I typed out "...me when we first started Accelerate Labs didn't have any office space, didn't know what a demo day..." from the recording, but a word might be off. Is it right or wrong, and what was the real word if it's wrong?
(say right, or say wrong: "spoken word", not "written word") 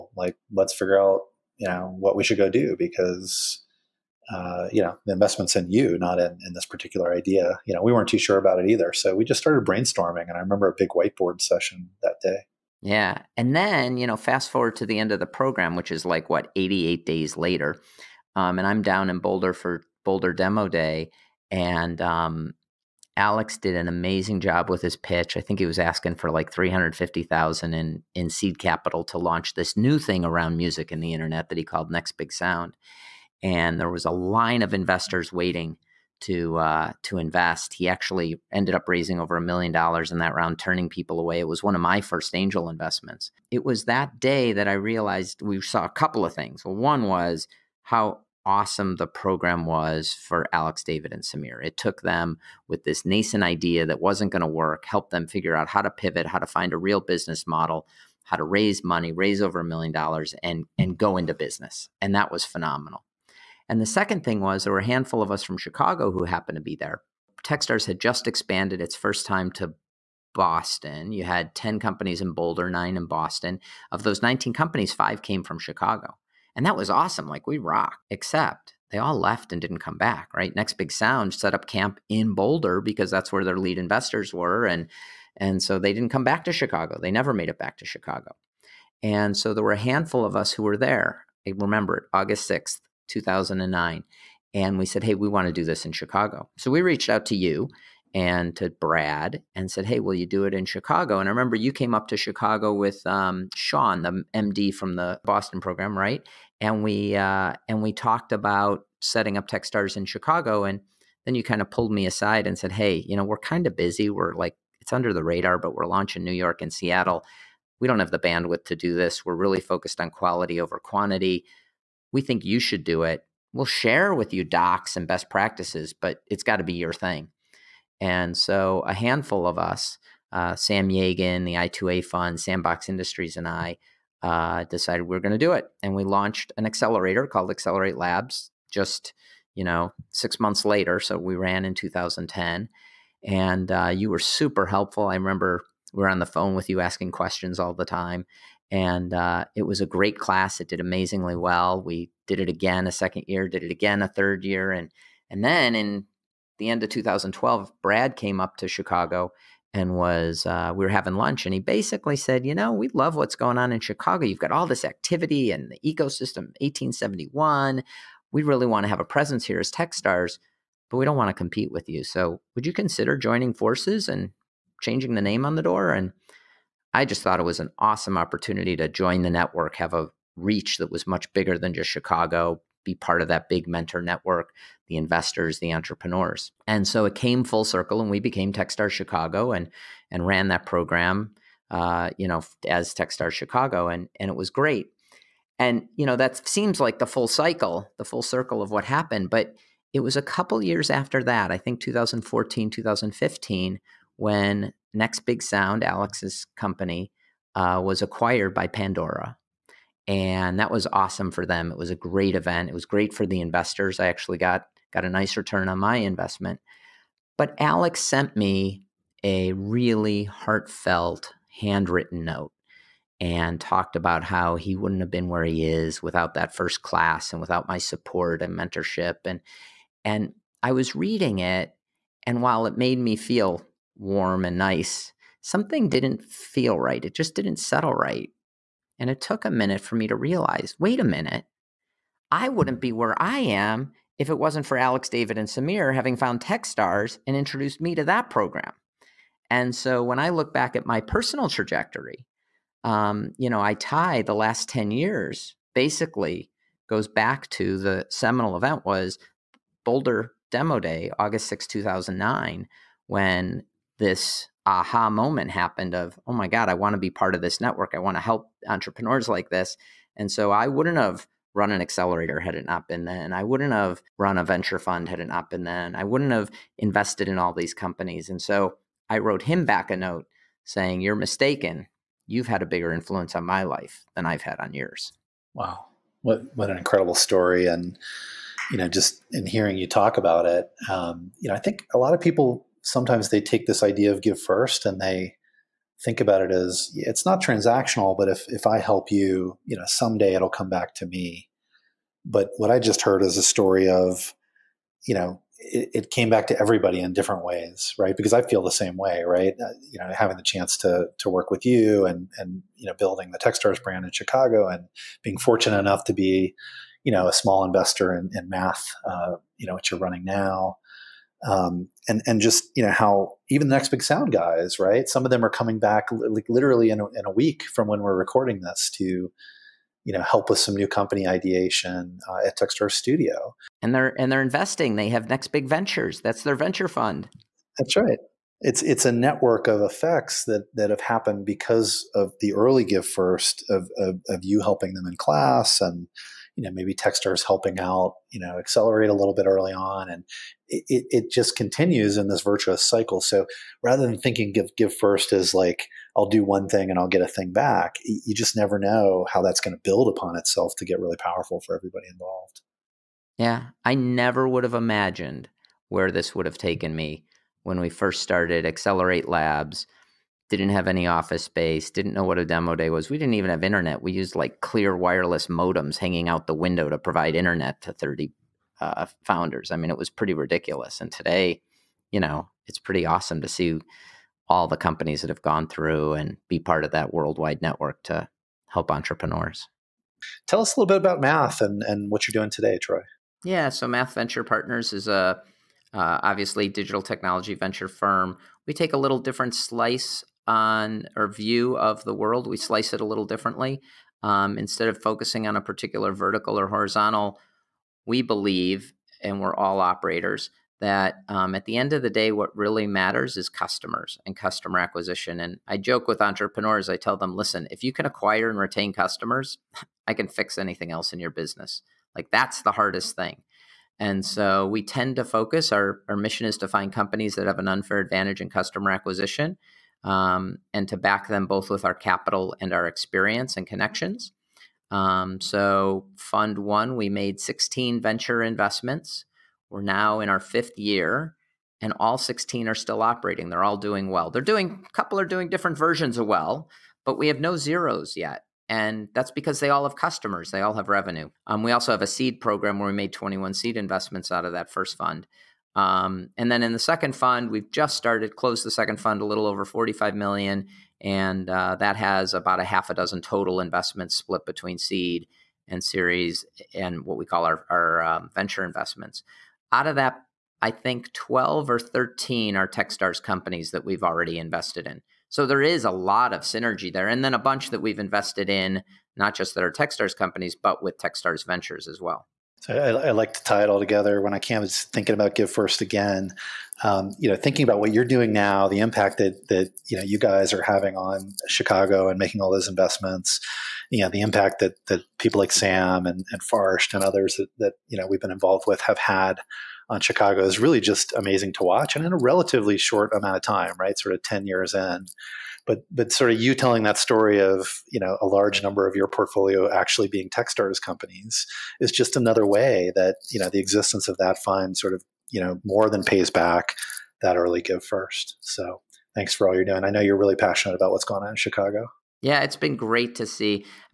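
right.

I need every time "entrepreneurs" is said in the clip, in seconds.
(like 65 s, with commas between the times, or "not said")
185 s, 268 s, 388 s, 416 s.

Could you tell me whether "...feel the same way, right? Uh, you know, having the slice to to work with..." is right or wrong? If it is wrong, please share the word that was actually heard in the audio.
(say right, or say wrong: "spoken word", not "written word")
wrong: "chance", not "slice".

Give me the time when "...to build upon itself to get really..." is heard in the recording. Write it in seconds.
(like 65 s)
359 s.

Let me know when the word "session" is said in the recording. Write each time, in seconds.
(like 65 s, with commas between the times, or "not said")
11 s.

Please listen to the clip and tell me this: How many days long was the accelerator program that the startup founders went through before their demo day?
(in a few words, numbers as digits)
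88.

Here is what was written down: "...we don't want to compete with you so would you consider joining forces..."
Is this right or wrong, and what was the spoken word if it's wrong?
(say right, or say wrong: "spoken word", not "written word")
right.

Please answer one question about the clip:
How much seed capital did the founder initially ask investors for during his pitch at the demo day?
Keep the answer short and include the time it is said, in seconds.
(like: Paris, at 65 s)
350,000, at 26 s.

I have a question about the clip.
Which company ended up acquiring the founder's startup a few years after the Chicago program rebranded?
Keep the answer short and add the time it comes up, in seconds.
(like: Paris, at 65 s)
Pandora, at 208 s.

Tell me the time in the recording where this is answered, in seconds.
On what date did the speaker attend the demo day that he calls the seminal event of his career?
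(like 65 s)
92 s.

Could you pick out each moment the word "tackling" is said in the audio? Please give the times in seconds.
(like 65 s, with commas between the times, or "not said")
not said.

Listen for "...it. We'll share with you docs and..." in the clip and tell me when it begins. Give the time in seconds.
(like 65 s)
123 s.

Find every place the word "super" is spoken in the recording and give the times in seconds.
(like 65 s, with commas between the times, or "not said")
144 s.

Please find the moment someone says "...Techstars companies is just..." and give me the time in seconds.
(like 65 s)
510 s.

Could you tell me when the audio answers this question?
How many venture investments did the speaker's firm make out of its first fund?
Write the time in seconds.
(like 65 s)
437 s.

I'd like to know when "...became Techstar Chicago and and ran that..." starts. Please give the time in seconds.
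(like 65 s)
188 s.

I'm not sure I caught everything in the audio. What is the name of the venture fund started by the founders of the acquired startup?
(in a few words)
Next Big Ventures.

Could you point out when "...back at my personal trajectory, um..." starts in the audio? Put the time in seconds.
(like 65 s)
250 s.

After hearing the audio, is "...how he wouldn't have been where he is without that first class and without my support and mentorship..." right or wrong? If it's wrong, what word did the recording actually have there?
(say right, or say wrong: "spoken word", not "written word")
right.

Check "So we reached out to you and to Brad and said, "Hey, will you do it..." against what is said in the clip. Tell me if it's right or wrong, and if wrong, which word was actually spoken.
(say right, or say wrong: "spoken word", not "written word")
right.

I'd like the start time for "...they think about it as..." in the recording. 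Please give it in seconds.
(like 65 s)
295 s.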